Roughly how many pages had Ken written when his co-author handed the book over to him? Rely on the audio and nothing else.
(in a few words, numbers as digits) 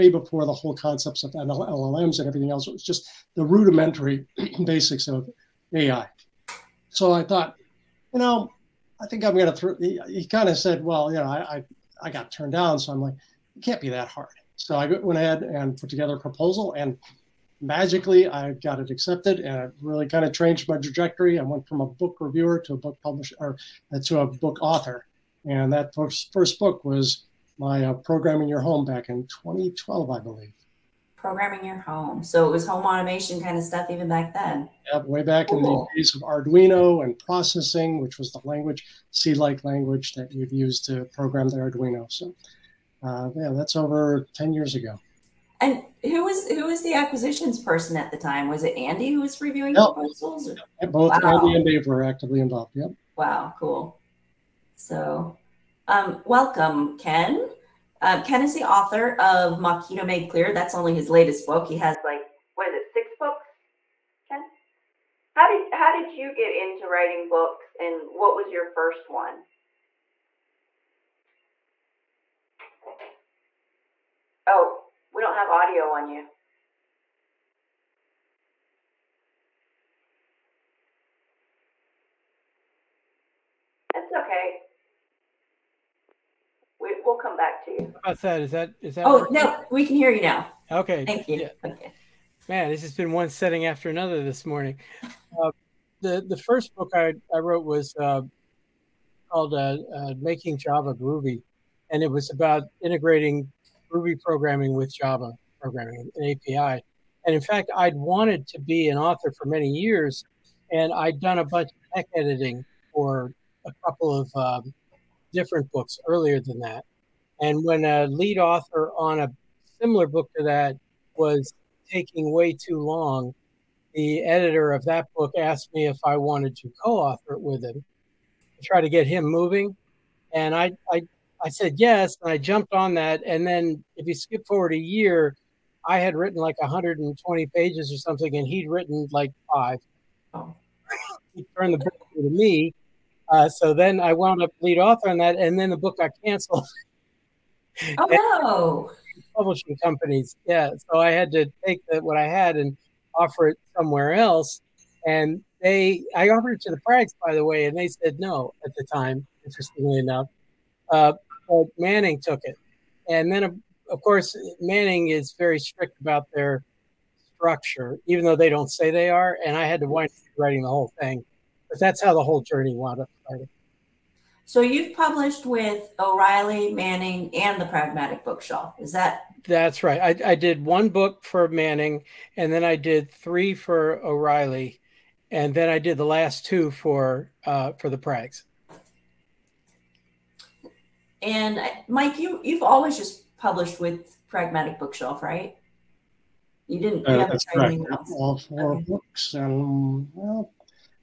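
120.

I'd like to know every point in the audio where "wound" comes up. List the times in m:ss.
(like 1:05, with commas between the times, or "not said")
2:24, 2:52.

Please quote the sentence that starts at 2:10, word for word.
And I, I, I said yes, and I jumped on that.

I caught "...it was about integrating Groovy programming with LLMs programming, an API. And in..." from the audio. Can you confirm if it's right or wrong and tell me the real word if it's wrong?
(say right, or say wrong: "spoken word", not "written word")
wrong: "Java", not "LLMs".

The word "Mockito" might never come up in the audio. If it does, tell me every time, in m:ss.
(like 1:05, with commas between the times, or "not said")
0:59.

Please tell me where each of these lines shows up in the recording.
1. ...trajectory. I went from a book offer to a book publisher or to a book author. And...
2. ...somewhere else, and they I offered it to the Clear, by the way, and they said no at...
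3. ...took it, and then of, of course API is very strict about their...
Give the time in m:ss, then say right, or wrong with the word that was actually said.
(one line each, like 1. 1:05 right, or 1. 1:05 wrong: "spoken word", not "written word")
1. 0:20 wrong: "reviewer", not "offer"
2. 2:33 wrong: "Prags", not "Clear"
3. 2:42 wrong: "Manning", not "API".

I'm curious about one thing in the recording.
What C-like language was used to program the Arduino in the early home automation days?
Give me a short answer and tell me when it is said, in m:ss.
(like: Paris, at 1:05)
Processing, at 0:37.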